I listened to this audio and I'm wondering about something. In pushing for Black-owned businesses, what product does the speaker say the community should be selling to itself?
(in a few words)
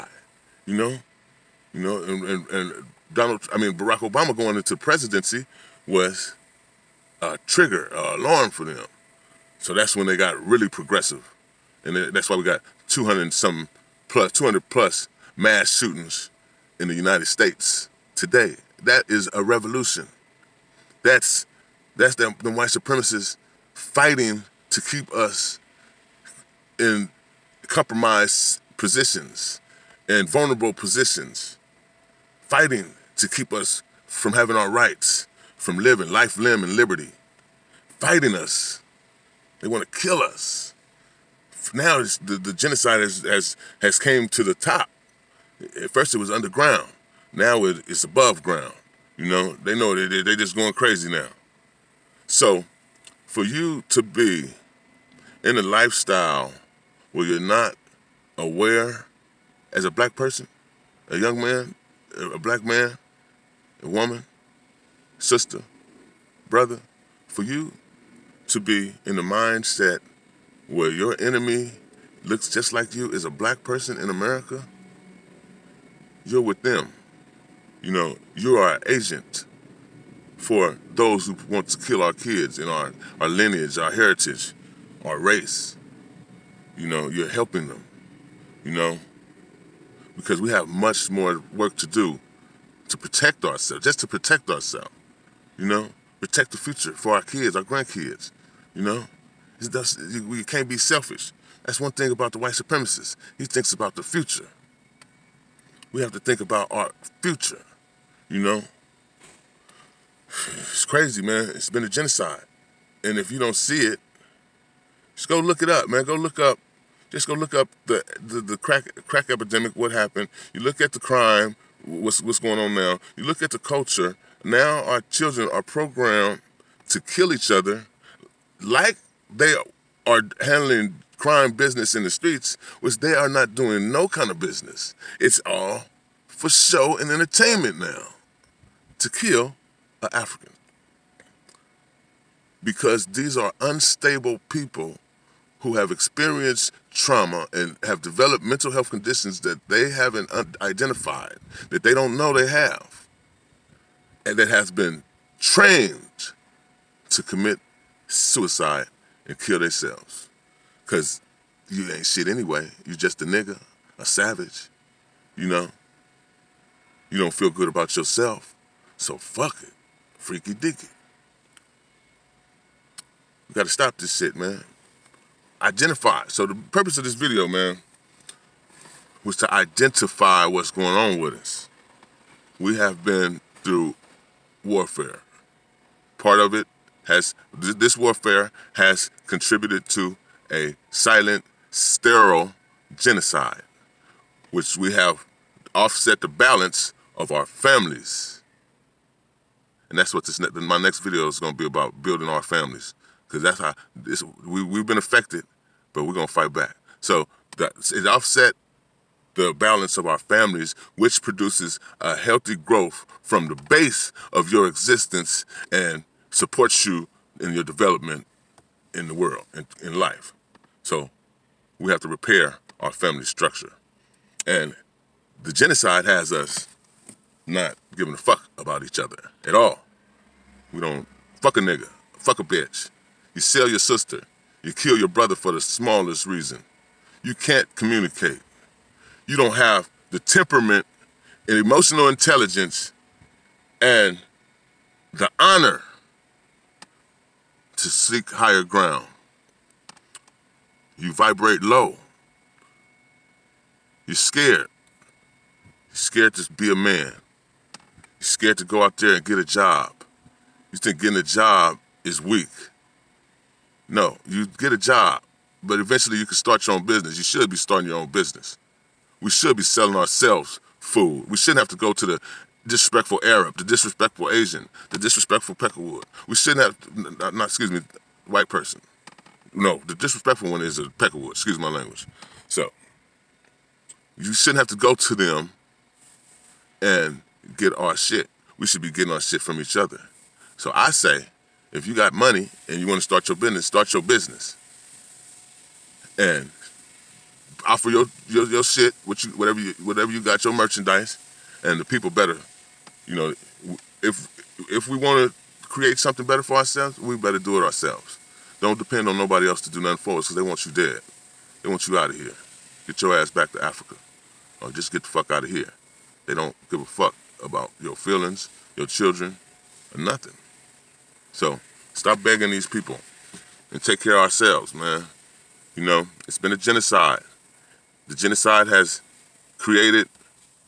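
food.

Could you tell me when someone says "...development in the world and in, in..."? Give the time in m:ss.
3:37.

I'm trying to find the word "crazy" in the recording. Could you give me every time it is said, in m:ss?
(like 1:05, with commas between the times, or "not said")
0:50, 1:50.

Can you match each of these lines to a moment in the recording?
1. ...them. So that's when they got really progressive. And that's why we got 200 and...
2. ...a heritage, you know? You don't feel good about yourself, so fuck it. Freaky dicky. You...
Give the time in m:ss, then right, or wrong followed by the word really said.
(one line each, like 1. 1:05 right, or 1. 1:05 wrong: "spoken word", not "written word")
1. 0:08 right
2. 2:43 wrong: "savage", not "heritage".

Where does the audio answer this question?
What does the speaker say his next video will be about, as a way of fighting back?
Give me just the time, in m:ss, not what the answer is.
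3:22.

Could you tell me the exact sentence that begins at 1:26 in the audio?
You know, you're helping them, you know, because we have much more work to do to protect ourselves, just to protect ourselves.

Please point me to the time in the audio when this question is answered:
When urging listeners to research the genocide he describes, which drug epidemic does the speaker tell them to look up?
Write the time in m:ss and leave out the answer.
1:59.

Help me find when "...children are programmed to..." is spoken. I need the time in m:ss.
2:05.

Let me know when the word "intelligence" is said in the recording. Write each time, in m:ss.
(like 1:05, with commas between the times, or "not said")
4:02.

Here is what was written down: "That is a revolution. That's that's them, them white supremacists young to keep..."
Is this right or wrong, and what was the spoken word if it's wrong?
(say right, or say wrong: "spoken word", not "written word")
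wrong: "fighting", not "young".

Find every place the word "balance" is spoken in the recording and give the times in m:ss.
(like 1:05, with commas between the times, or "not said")
3:16, 3:29.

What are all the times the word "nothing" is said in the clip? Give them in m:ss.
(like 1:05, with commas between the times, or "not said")
5:09, 5:19.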